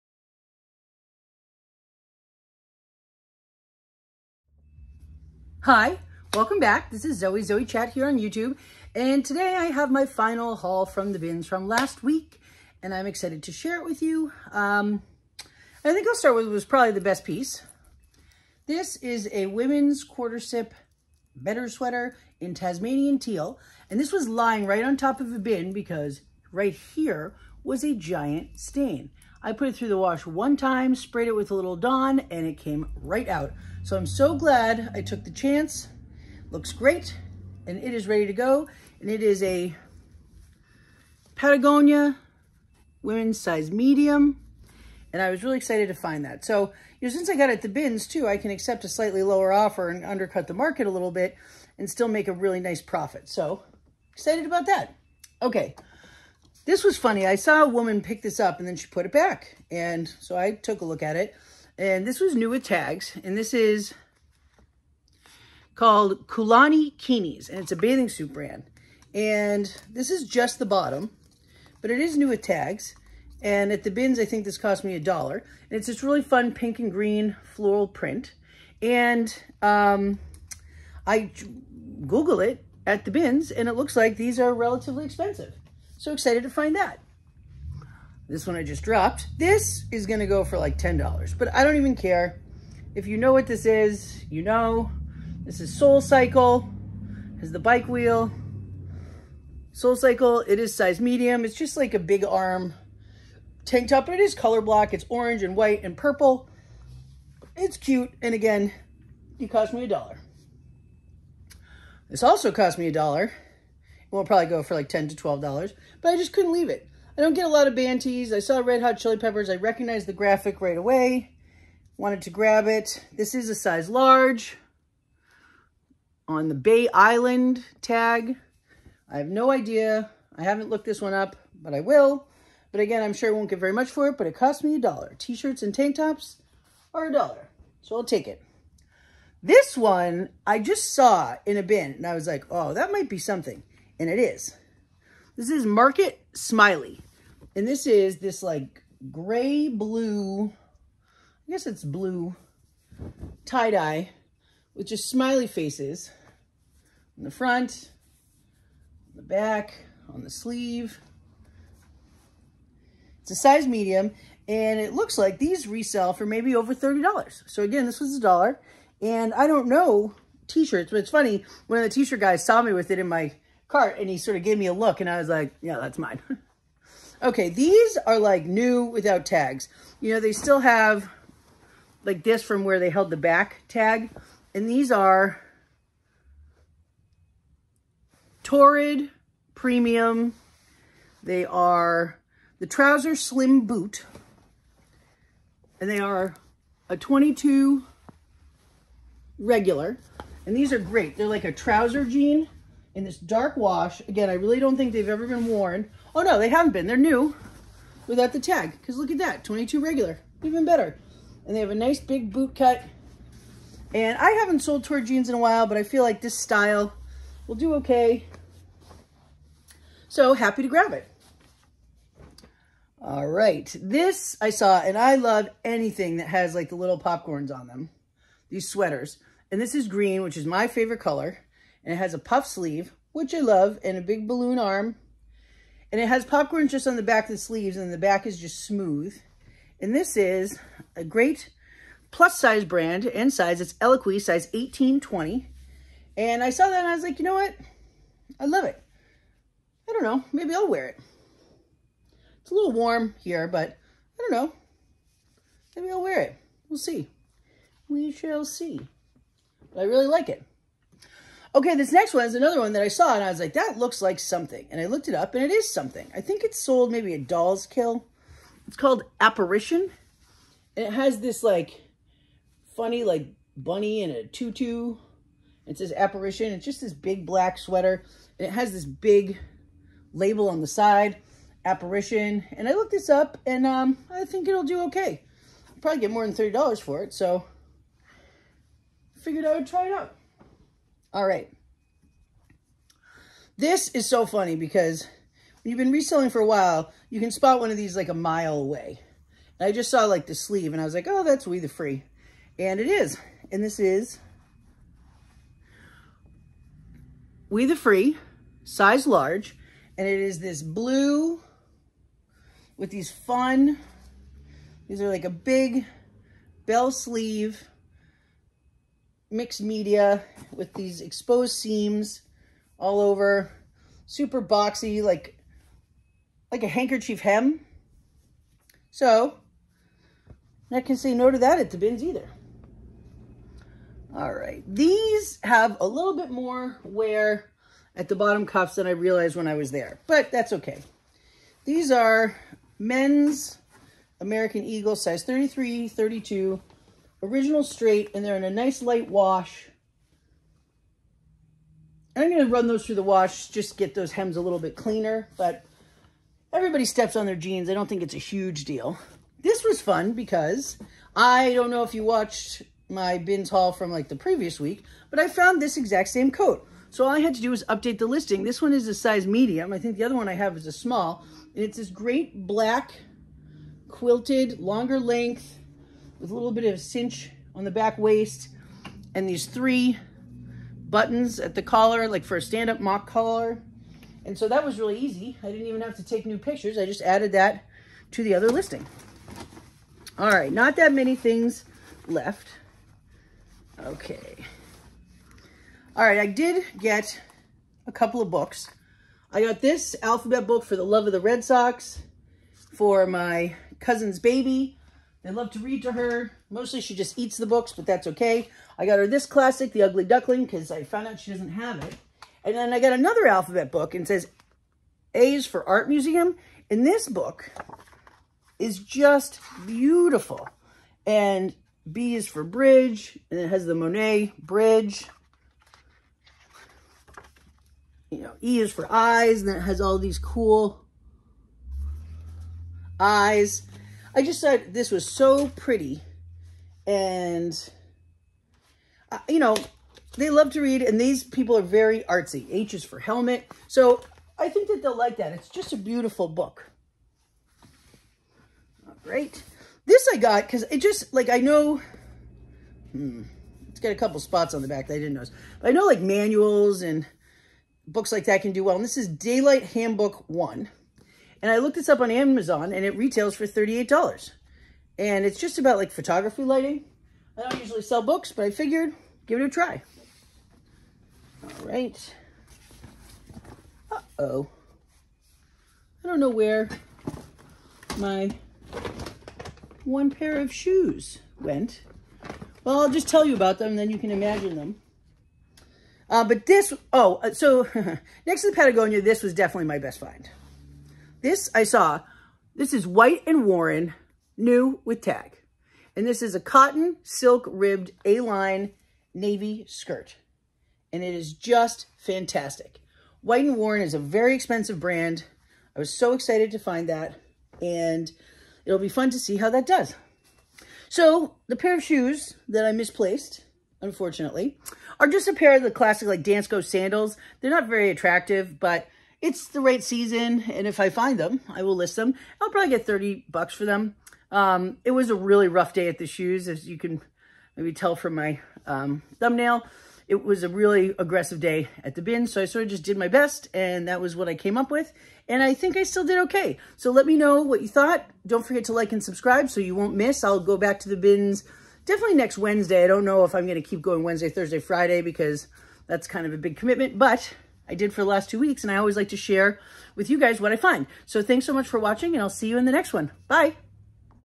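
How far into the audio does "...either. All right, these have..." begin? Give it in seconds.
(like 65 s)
332 s.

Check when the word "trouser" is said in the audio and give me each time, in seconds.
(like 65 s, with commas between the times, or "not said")
192 s, 201 s.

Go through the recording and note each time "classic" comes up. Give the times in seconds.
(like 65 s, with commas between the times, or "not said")
409 s, 515 s.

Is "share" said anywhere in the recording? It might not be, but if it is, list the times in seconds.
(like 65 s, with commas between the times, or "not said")
13 s, 549 s.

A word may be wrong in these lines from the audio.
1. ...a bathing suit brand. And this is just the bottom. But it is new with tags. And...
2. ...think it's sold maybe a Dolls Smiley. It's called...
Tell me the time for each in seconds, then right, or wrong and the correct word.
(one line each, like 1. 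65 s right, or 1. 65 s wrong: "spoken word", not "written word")
1. 67 s right
2. 266 s wrong: "Kill", not "Smiley".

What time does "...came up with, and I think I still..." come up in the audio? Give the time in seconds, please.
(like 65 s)
534 s.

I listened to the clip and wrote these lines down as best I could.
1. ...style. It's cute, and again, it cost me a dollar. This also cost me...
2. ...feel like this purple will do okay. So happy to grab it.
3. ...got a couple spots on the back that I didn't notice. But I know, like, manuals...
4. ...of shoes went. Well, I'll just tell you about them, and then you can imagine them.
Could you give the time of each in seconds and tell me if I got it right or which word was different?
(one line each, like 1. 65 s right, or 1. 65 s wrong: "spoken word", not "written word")
1. 105 s wrong: "purple", not "style"
2. 215 s wrong: "style", not "purple"
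3. 453 s right
4. 480 s right.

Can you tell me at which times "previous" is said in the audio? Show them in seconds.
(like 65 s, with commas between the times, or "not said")
364 s.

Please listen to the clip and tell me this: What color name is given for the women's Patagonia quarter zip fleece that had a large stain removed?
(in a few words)
Tasmanian teal.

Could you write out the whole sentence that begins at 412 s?
And then I got another alphabet book and says A is for Art Museum.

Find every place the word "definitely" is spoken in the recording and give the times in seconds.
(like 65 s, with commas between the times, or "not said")
489 s, 541 s.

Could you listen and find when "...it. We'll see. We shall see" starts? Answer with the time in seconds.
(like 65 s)
256 s.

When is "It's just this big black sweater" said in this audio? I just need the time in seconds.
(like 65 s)
276 s.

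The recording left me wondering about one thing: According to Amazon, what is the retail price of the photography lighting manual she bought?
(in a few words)
$38.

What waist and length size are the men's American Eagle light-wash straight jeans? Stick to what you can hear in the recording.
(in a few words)
33, 32.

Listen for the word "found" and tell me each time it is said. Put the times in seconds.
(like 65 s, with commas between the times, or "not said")
365 s, 410 s.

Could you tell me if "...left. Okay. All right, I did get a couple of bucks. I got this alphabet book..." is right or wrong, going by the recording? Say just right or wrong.
wrong.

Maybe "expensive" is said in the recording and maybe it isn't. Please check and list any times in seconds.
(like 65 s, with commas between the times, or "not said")
85 s, 504 s.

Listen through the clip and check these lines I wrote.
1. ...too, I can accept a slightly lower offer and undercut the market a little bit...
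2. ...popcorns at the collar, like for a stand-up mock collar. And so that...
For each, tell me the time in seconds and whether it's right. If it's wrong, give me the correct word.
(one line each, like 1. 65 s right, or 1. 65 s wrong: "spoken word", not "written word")
1. 48 s right
2. 380 s wrong: "buttons", not "popcorns".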